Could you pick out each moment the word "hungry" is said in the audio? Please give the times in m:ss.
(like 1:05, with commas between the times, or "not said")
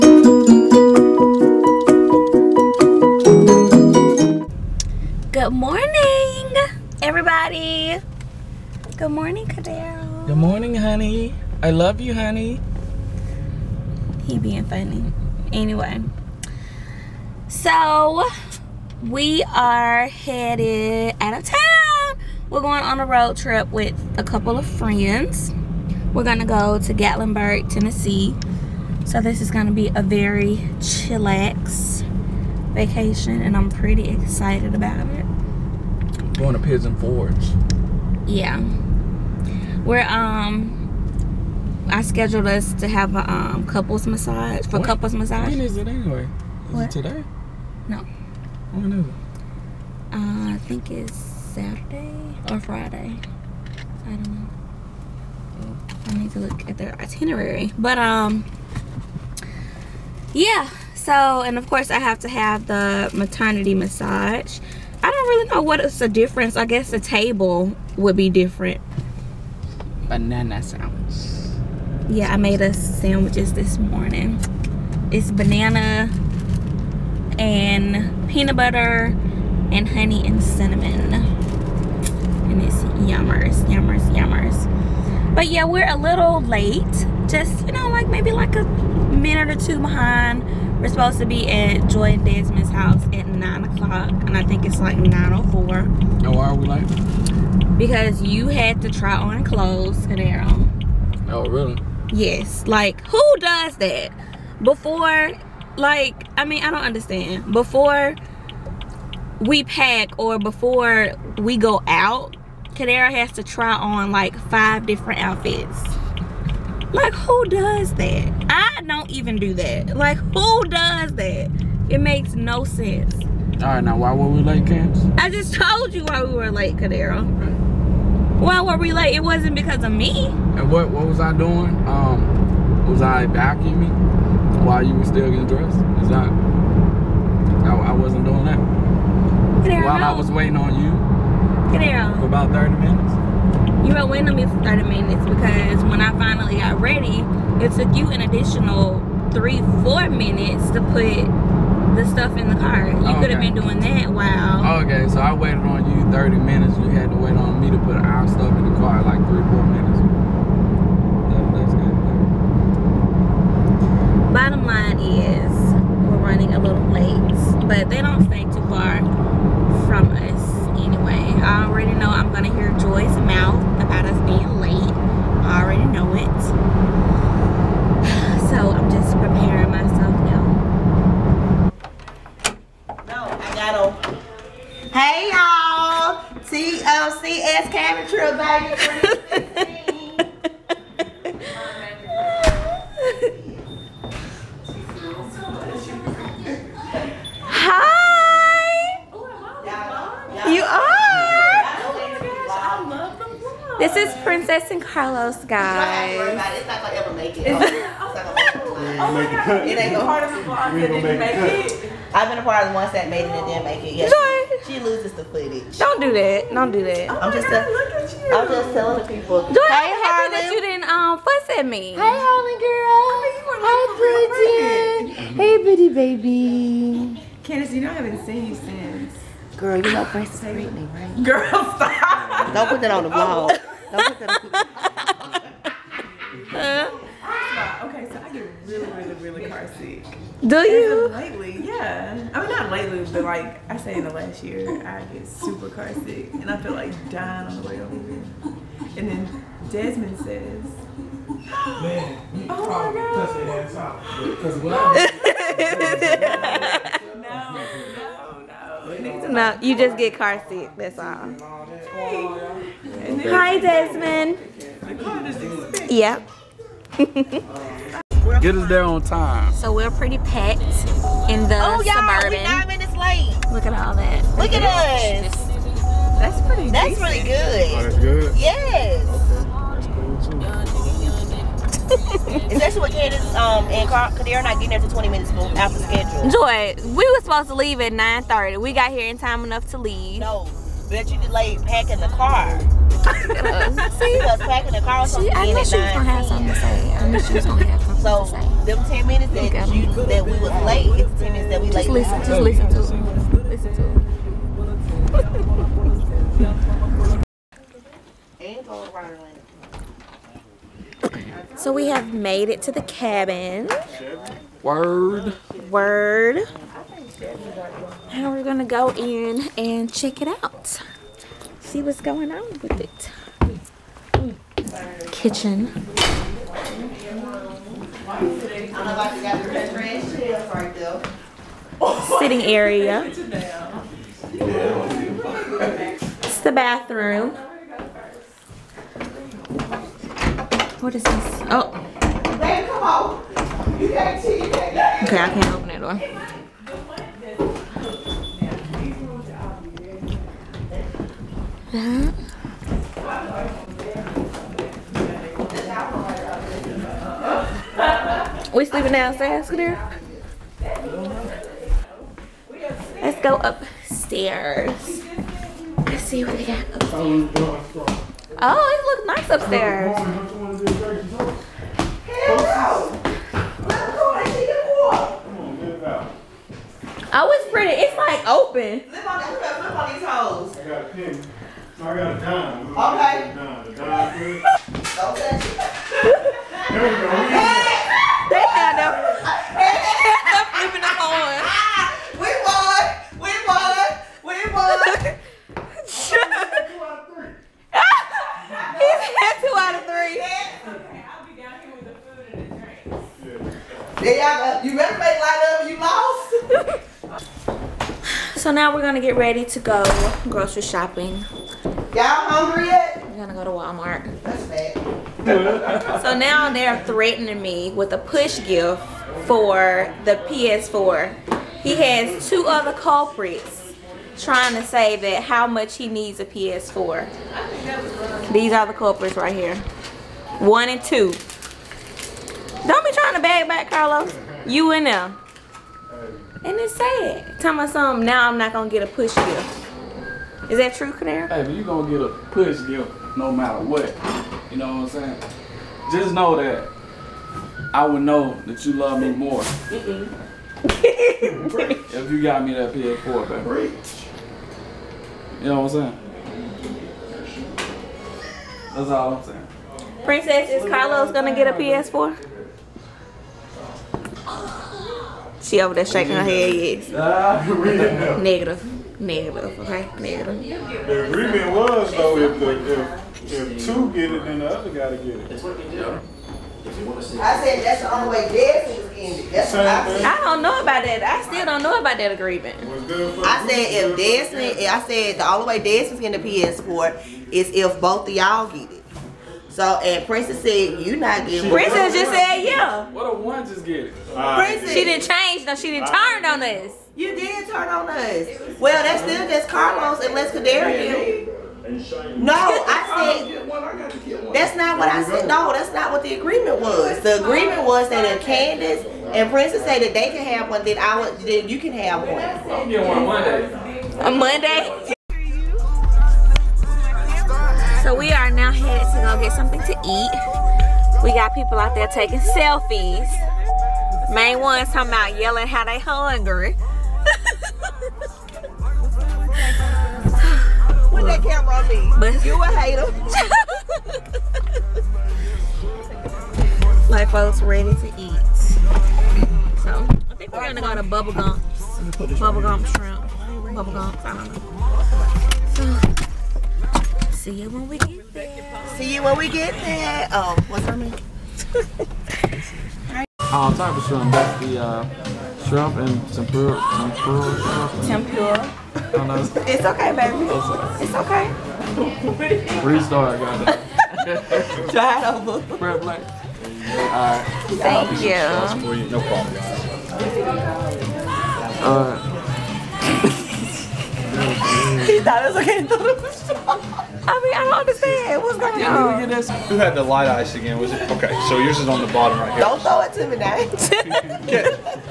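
6:52, 8:45.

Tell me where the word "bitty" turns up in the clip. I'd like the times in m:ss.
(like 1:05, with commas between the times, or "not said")
3:45.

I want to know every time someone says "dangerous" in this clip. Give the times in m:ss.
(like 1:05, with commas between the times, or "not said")
not said.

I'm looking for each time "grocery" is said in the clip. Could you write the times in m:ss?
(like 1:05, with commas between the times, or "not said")
6:50.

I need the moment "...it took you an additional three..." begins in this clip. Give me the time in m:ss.
2:27.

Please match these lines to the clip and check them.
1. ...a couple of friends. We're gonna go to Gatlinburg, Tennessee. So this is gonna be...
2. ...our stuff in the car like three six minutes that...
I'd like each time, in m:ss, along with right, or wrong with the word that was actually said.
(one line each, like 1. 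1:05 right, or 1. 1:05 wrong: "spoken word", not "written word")
1. 0:24 right
2. 2:37 wrong: "four", not "six".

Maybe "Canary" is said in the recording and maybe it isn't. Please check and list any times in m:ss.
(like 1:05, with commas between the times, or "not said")
7:20.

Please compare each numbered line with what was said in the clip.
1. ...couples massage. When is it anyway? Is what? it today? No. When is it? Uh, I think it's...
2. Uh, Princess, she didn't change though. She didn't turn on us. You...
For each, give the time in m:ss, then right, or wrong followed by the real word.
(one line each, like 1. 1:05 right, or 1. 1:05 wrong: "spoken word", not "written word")
1. 0:44 right
2. 8:14 right.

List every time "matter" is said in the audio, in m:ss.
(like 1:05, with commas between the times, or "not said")
7:23.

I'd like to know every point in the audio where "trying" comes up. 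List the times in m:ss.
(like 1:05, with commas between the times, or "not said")
7:04, 7:12.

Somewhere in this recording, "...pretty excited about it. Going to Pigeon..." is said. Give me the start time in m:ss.
0:33.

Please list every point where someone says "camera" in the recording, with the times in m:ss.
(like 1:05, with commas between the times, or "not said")
3:07, 8:51.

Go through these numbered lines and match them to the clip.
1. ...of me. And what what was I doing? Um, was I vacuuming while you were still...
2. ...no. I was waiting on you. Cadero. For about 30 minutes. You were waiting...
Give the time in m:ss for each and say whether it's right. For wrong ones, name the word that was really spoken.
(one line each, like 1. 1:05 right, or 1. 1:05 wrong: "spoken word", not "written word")
1. 2:09 right
2. 2:19 right.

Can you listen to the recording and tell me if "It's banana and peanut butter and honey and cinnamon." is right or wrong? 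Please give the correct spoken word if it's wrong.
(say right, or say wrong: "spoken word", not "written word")
right.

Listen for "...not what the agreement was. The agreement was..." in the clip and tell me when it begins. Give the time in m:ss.
8:25.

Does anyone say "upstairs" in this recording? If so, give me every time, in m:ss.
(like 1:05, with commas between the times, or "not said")
6:03, 6:09.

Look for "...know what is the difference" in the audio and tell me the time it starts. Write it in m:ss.
1:05.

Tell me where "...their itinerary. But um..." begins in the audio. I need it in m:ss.
0:56.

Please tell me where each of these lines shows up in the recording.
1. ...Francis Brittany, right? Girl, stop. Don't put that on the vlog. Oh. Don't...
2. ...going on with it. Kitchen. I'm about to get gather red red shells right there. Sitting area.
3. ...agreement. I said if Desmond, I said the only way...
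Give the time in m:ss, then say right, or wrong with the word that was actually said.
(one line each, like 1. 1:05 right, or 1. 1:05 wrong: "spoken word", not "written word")
1. 3:50 right
2. 5:22 right
3. 8:02 right.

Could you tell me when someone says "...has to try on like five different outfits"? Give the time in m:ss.
1:53.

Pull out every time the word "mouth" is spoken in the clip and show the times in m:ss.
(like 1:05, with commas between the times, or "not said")
2:53.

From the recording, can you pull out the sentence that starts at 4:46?
Joy, we were supposed to leave at 9:30.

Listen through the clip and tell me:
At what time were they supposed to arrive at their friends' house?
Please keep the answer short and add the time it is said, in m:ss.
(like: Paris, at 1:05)
9 o'clock, at 1:33.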